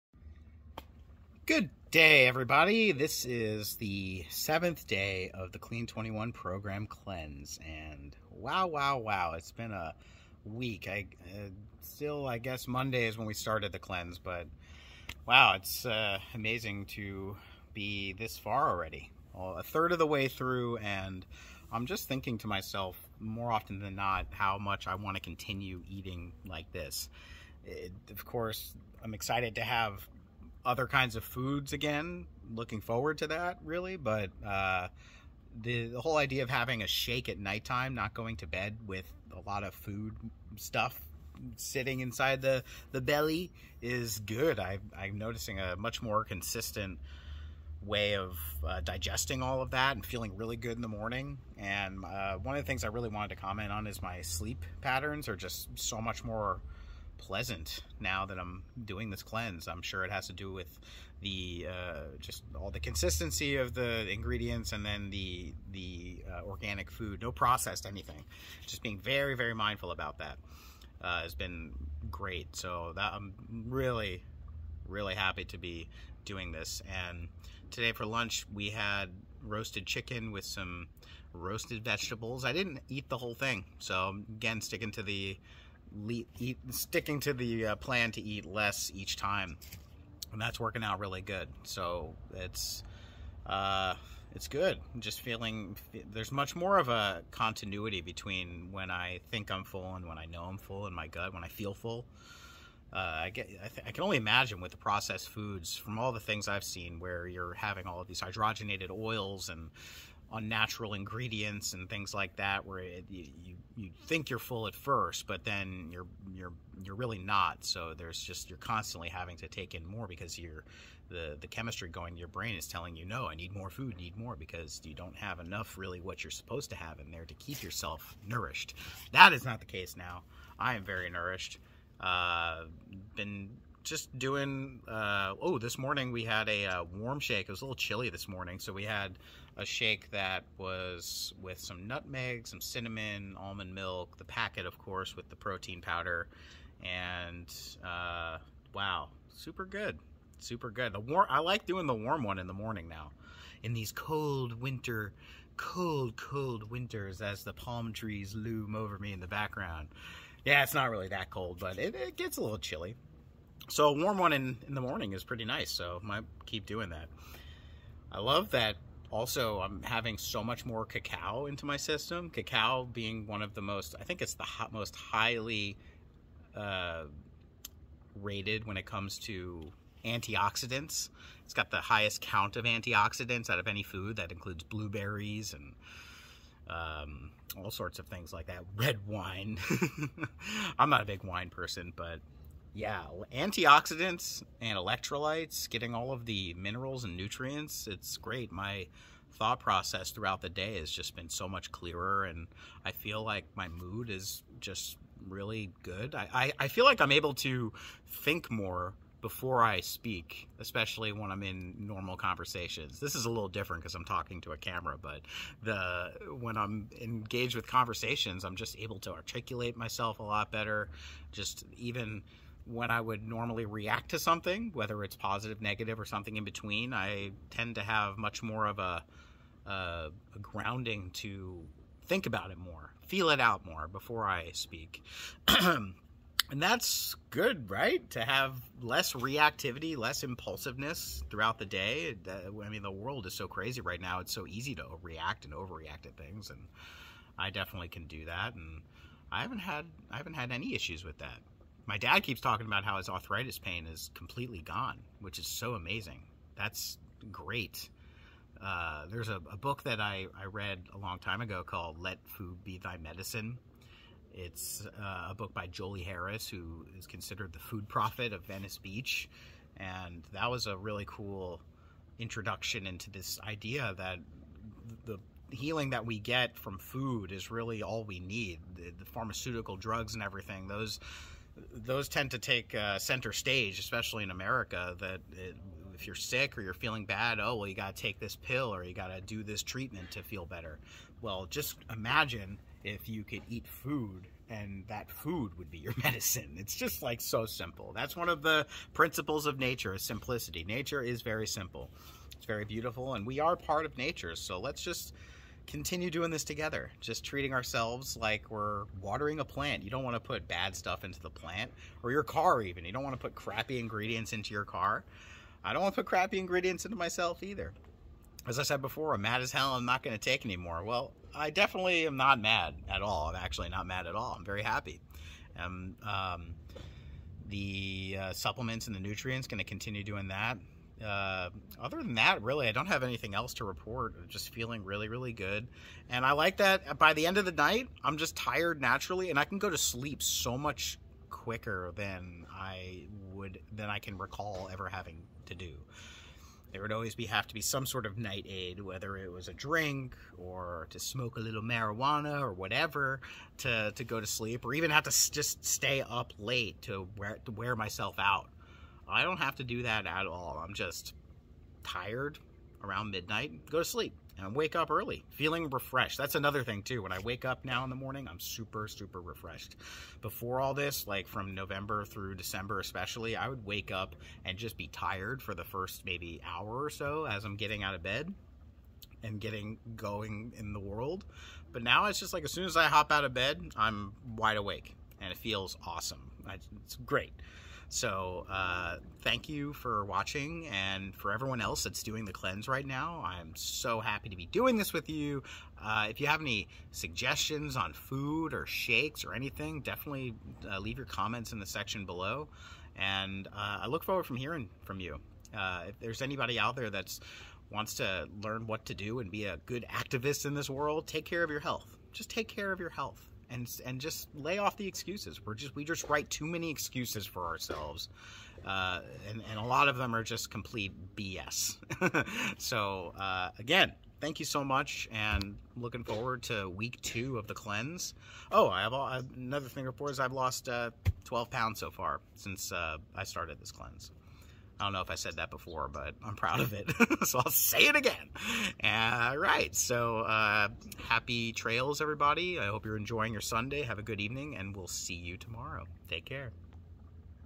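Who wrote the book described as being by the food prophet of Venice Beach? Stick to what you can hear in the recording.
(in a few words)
Jolie Harris.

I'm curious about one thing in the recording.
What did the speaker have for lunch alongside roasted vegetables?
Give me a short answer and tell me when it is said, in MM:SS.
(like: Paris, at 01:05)
Roasted chicken, at 01:19.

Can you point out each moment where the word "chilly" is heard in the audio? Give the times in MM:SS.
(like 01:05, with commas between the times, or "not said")
02:17, 02:42.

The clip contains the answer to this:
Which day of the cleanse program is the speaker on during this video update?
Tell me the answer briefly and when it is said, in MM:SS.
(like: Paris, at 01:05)
7th, at 00:04.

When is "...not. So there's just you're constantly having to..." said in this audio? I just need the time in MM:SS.
01:57.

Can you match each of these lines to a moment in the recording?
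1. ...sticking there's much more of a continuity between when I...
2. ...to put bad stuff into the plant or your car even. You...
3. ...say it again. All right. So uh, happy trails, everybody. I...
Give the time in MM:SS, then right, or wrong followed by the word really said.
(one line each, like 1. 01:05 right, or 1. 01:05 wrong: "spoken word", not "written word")
1. 01:35 wrong: "feeling", not "sticking"
2. 05:10 right
3. 07:17 right.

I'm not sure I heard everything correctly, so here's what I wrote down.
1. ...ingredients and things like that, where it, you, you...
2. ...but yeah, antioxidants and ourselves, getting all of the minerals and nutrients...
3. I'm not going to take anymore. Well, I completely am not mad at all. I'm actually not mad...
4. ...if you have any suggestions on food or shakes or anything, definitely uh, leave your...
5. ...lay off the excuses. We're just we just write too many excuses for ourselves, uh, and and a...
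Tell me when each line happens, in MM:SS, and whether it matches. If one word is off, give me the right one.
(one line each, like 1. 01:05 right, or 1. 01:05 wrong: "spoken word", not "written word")
1. 01:50 right
2. 03:11 wrong: "electrolytes", not "ourselves"
3. 05:19 wrong: "definitely", not "completely"
4. 06:36 right
5. 06:54 right.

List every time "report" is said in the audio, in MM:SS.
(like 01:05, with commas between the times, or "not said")
05:33, 07:09.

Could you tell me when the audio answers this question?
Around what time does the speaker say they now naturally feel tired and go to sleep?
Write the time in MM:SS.
06:03.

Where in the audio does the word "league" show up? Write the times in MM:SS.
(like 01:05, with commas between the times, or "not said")
not said.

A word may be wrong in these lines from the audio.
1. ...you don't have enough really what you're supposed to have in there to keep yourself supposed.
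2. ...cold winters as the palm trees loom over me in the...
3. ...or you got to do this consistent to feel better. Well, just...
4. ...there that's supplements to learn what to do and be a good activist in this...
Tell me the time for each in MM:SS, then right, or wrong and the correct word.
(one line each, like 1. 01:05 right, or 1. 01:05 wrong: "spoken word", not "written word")
1. 02:04 wrong: "nourished", not "supposed"
2. 02:36 right
3. 04:48 wrong: "treatment", not "consistent"
4. 06:46 wrong: "wants", not "supplements".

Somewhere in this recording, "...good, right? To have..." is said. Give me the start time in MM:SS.
03:57.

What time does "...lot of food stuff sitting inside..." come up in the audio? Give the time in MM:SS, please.
00:39.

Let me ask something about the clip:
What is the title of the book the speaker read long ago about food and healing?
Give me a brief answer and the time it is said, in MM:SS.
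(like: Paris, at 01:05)
Let Food Be Thy Medicine, at 04:21.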